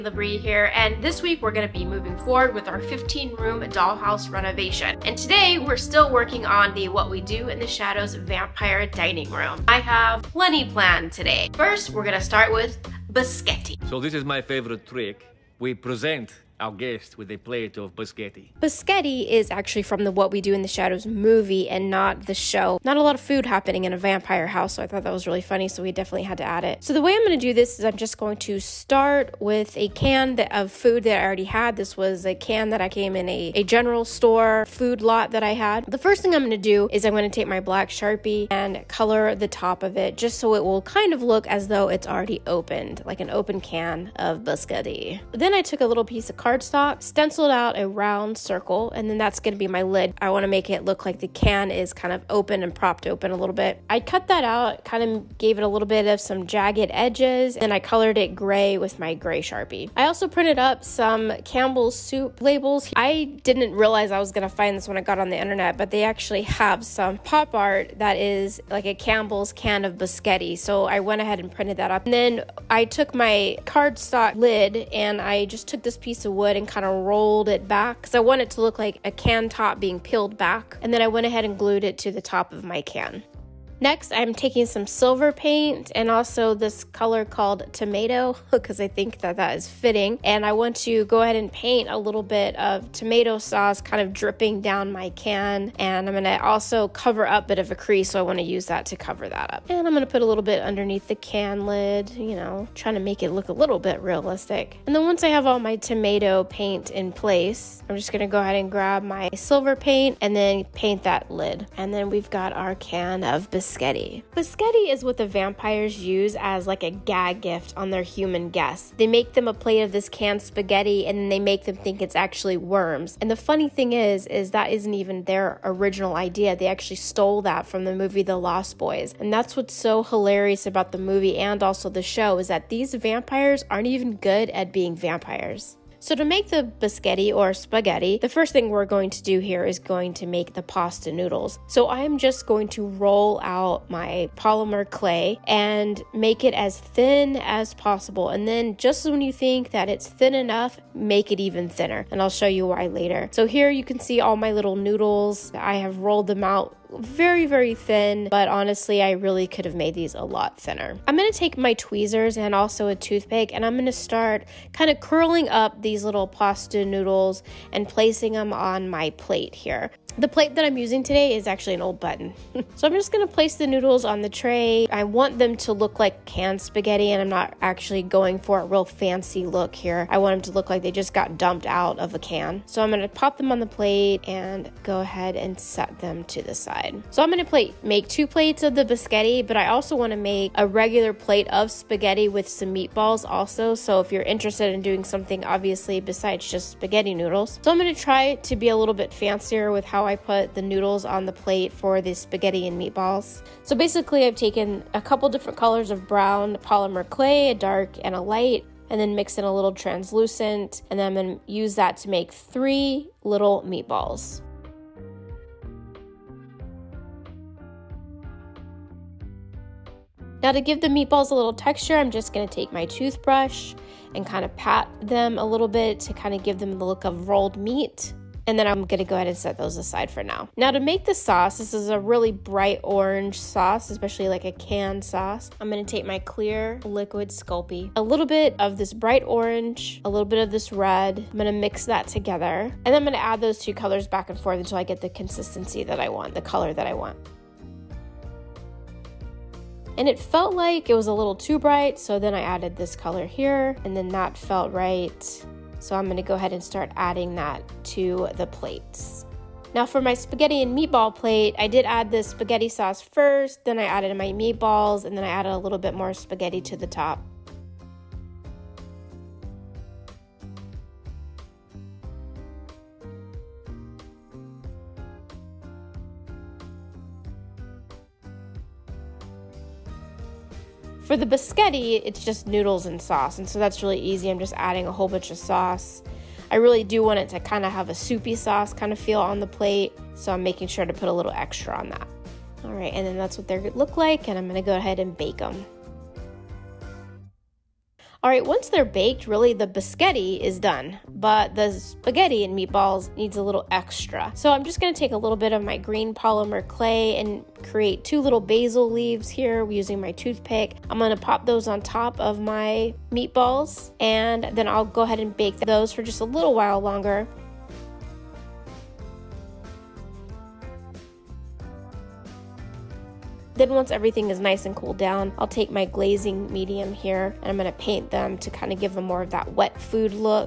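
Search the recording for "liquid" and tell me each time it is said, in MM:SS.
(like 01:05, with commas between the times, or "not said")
03:56.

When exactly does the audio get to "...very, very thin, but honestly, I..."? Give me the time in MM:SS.
02:36.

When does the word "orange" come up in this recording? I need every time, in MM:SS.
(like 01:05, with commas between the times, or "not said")
03:52, 03:59.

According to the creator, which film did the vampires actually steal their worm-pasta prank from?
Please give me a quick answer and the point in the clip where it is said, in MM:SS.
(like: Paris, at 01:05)
The Lost Boys, at 02:08.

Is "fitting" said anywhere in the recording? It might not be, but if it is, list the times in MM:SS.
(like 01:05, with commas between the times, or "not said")
01:29.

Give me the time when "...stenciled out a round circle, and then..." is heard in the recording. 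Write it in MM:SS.
00:47.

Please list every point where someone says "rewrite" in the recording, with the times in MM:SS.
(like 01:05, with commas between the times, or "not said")
not said.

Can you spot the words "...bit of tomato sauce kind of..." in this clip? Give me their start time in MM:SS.
01:32.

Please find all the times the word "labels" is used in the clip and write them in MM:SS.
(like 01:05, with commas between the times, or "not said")
01:02.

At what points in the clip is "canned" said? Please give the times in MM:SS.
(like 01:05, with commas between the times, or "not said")
02:00, 02:56, 03:54.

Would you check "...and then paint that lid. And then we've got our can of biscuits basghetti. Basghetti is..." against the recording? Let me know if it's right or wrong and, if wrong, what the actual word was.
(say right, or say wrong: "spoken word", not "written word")
right.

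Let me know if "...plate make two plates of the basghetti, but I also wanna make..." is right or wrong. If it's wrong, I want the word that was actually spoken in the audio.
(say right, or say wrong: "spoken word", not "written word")
right.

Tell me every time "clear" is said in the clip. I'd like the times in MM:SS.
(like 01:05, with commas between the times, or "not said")
03:56.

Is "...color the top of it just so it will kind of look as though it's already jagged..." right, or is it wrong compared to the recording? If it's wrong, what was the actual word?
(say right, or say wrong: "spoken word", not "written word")
wrong: "opened", not "jagged".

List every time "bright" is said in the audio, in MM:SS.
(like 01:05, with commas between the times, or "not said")
03:52, 03:58, 04:11.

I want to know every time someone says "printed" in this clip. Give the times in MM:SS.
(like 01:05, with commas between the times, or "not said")
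01:00, 01:11.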